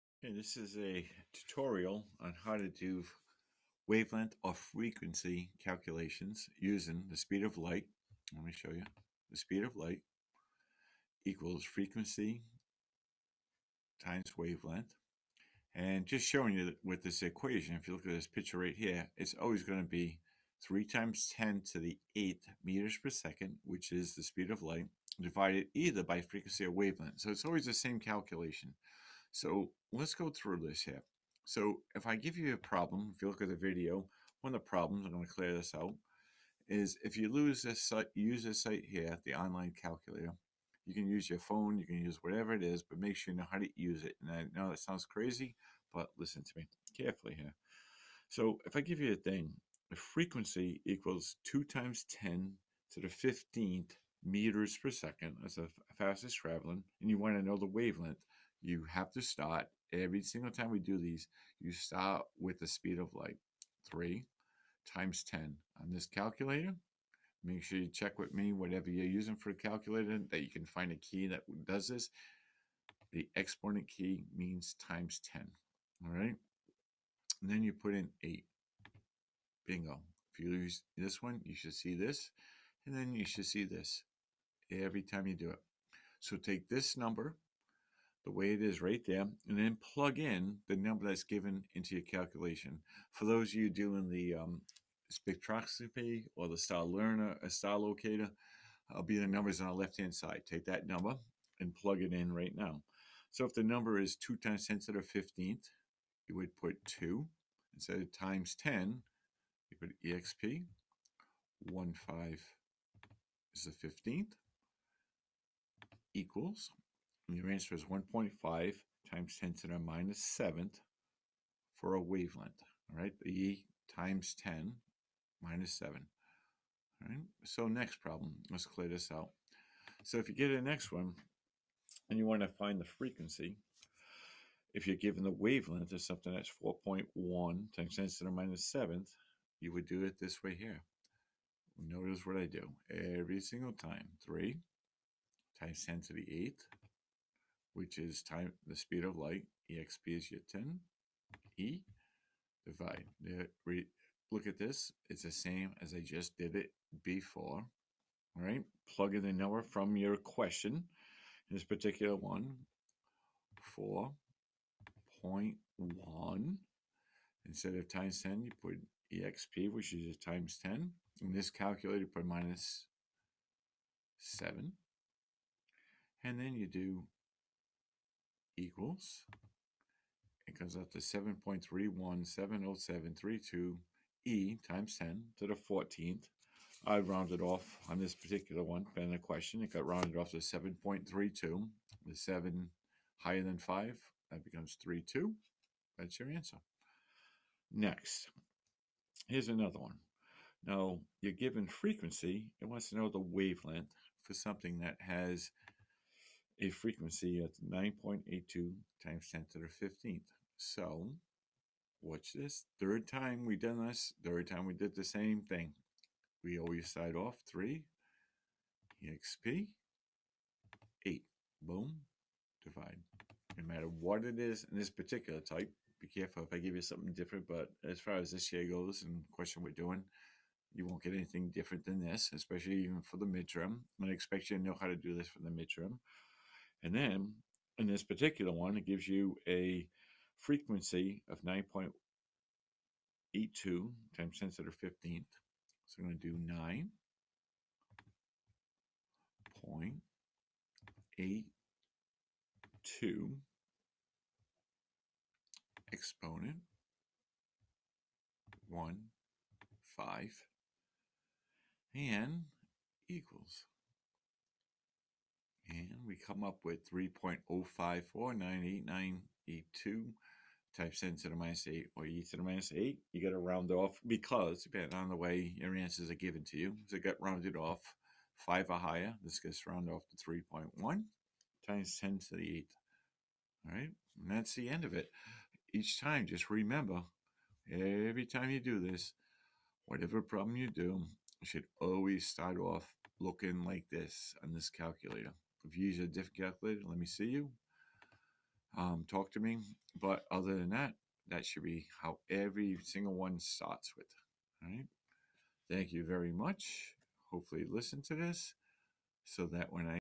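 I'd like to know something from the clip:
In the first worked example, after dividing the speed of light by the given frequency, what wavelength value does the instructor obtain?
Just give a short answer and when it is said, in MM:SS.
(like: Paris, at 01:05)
1.5 times 10 to the -7, at 01:57.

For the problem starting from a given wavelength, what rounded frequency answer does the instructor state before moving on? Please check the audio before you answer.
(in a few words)
7.32.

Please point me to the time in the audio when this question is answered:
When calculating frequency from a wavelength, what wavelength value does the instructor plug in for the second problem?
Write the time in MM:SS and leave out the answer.
02:16.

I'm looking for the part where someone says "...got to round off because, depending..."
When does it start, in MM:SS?
04:33.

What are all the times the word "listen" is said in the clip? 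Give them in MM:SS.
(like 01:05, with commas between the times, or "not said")
00:46, 05:07.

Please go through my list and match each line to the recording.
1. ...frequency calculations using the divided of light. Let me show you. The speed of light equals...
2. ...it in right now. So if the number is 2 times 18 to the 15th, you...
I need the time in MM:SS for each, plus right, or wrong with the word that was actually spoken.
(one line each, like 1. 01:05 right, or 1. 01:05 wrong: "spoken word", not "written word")
1. 00:04 wrong: "speed", not "divided"
2. 01:42 wrong: "10", not "18".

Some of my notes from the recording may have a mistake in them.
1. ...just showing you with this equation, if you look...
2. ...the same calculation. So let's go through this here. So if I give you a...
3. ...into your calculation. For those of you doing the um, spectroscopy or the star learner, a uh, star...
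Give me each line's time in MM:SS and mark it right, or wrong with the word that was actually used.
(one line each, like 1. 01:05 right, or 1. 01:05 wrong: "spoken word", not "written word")
1. 00:16 right
2. 00:27 right
3. 01:31 right.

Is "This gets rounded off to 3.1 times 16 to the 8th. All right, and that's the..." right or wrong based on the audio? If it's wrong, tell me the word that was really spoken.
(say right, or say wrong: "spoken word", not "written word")
wrong: "10", not "16".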